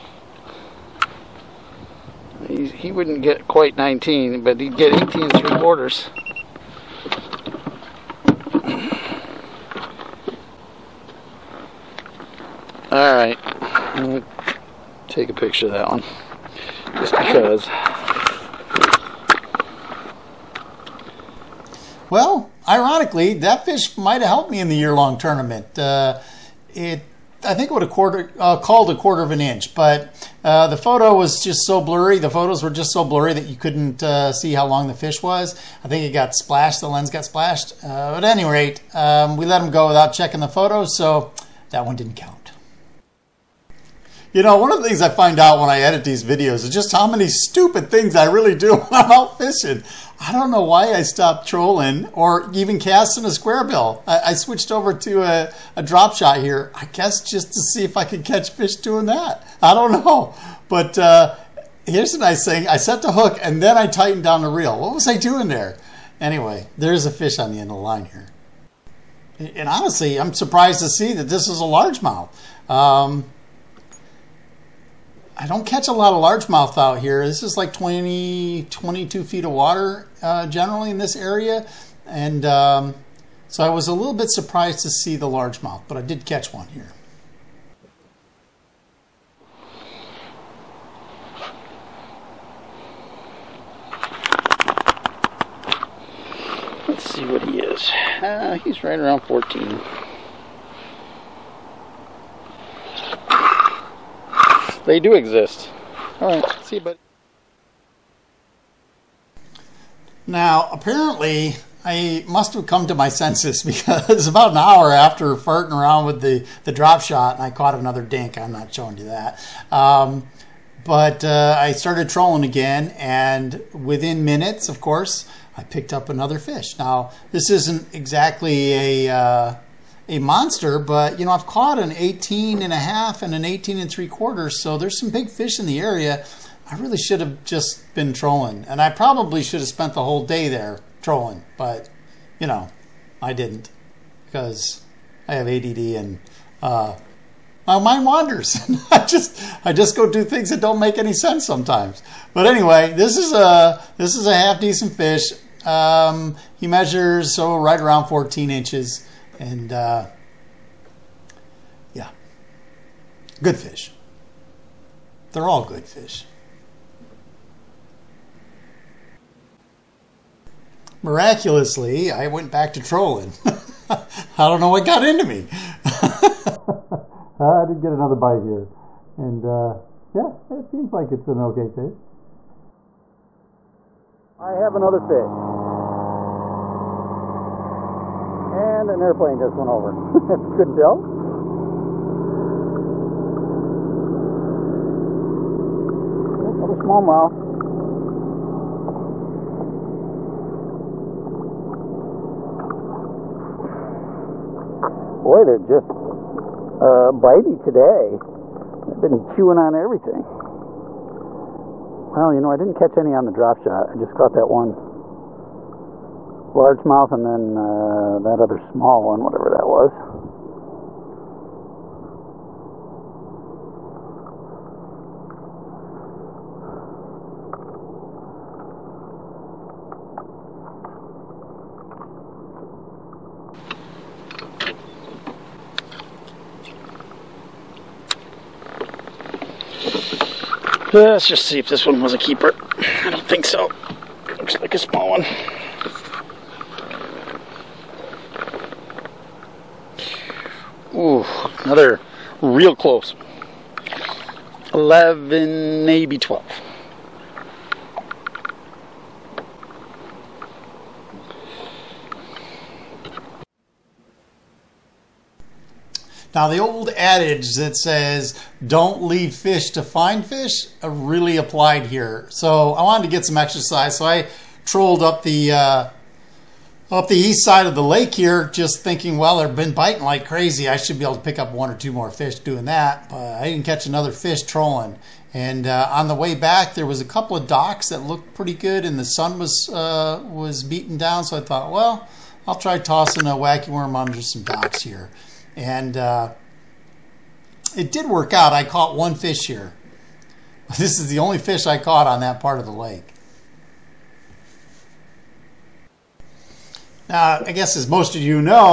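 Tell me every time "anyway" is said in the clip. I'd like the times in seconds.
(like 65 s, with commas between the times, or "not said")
66 s, 152 s.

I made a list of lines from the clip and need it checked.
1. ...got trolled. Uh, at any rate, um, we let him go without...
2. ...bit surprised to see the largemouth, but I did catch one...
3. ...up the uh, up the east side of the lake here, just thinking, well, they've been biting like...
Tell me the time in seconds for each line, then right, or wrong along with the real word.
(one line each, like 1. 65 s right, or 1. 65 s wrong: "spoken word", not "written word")
1. 37 s wrong: "splashed", not "trolled"
2. 84 s right
3. 275 s right.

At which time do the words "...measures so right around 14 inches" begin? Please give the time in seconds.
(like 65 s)
156 s.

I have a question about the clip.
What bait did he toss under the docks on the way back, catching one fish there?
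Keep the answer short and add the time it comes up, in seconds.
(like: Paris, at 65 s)
Wacky worm, at 293 s.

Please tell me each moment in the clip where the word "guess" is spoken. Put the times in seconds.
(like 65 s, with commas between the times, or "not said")
56 s, 307 s.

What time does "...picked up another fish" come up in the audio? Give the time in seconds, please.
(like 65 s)
125 s.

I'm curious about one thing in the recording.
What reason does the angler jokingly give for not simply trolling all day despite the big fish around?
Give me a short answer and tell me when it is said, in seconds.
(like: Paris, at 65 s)
ADD, at 145 s.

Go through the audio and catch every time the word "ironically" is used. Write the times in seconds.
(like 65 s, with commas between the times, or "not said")
22 s.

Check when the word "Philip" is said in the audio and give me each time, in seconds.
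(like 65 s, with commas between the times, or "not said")
not said.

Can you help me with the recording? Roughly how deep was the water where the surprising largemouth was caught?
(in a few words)
20 to 22 feet.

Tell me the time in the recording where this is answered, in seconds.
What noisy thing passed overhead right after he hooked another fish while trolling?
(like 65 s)
188 s.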